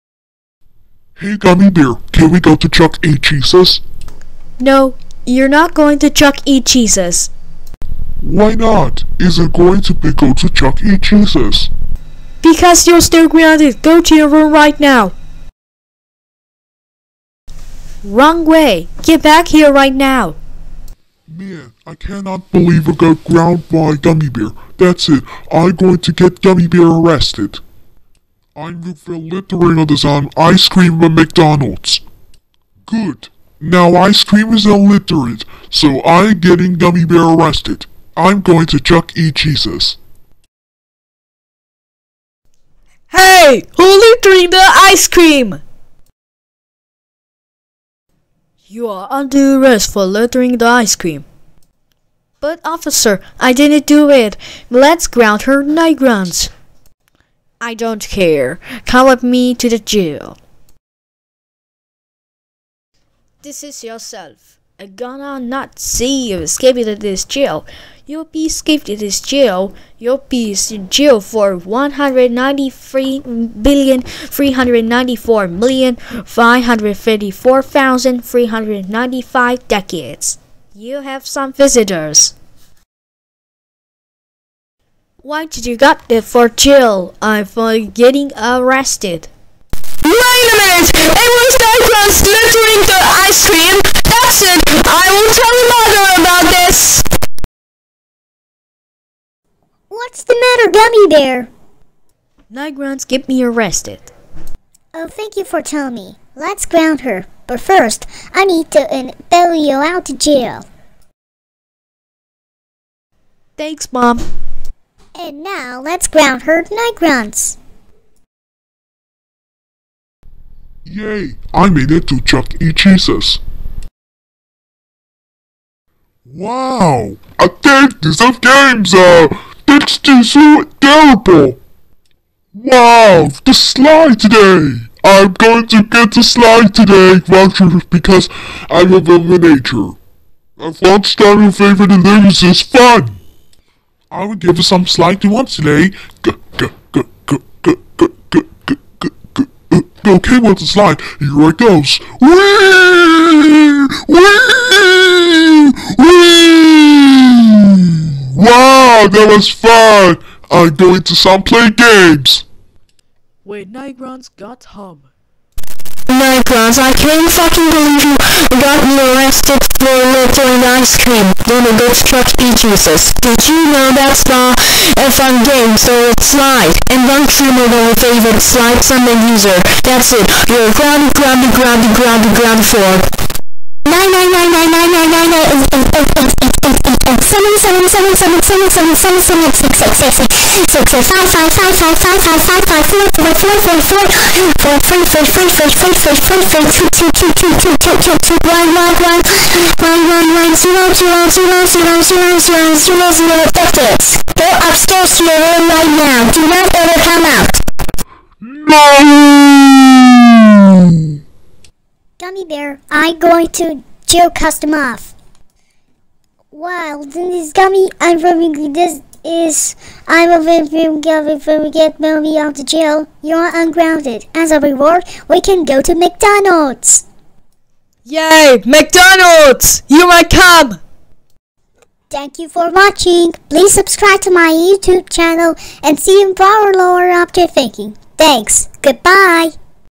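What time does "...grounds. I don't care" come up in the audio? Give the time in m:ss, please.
0:55.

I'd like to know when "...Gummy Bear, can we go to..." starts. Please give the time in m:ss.
0:01.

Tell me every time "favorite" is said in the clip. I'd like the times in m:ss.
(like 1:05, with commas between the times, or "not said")
2:21, 2:57.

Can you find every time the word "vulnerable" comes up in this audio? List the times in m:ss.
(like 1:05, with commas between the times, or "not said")
not said.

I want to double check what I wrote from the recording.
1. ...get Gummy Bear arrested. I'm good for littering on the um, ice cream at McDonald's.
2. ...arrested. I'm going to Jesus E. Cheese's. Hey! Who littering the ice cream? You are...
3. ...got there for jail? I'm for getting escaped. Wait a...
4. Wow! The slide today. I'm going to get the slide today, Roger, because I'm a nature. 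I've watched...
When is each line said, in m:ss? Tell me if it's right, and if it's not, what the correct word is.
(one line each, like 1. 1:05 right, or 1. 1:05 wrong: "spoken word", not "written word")
1. 0:26 right
2. 0:37 wrong: "Chuck", not "Jesus"
3. 1:25 wrong: "arrested", not "escaped"
4. 2:12 right.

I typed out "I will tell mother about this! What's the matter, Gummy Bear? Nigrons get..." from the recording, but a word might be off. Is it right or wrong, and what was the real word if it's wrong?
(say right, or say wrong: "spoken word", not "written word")
right.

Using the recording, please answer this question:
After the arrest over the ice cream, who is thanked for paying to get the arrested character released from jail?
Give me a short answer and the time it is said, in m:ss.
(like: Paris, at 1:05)
Mom, at 1:53.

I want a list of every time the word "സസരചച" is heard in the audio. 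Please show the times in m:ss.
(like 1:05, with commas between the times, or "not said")
2:24.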